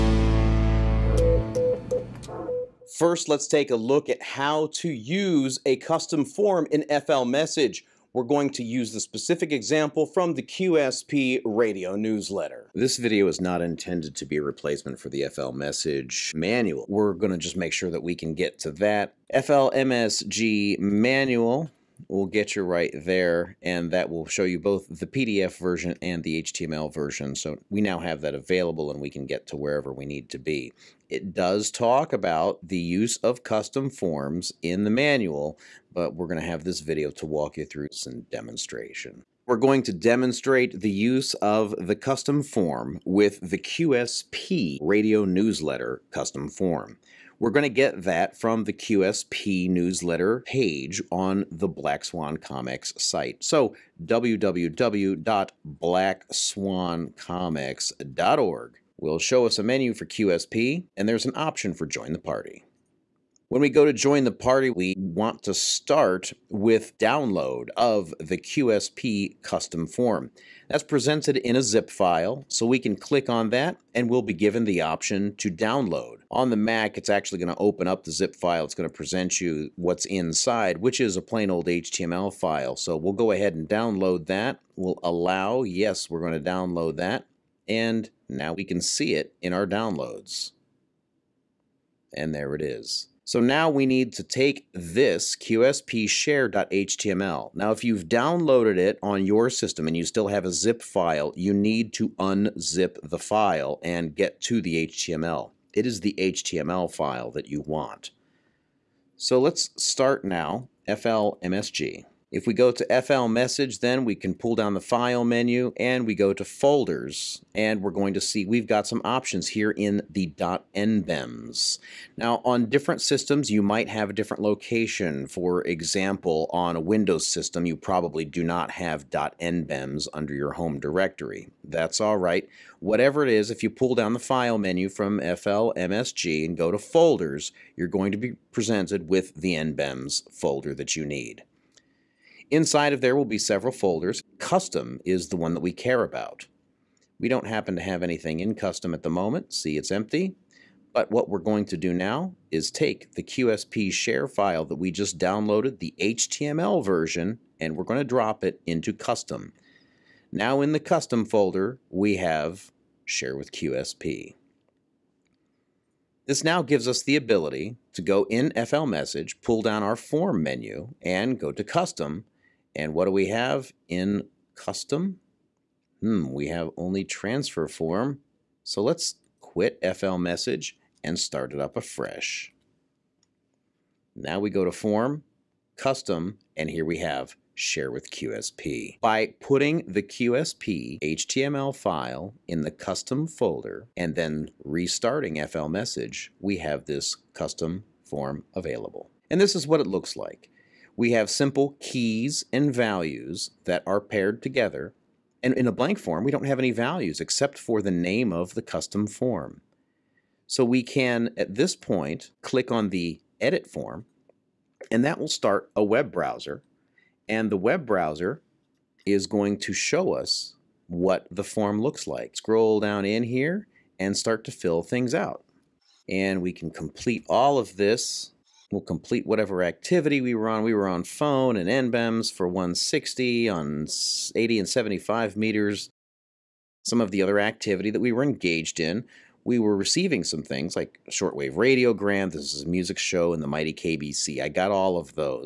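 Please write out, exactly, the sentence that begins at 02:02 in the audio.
Now on different systems, you might have a different location.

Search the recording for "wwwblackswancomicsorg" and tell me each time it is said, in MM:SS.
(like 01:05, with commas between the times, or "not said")
00:54.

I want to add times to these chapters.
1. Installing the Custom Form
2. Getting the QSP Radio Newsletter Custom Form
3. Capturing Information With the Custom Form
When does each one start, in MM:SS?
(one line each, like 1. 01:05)
1. 01:34
2. 00:38
3. 03:18.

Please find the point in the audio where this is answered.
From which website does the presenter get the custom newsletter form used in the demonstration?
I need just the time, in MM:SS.
00:54.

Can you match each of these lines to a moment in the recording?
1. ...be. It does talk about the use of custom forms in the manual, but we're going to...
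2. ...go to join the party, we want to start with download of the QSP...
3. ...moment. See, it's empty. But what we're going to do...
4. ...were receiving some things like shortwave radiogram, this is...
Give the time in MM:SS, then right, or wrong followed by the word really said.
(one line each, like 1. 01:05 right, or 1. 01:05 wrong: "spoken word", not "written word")
1. 00:30 right
2. 01:03 right
3. 02:29 right
4. 03:59 right.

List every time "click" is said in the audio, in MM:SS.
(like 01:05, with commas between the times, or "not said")
01:12, 03:32.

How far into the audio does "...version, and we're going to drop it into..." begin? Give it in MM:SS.
02:36.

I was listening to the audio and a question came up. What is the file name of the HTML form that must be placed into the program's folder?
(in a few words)
qspshare.html.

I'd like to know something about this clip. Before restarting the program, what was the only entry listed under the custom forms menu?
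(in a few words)
transfer form.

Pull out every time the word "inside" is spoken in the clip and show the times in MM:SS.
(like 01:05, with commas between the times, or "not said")
01:20, 02:22.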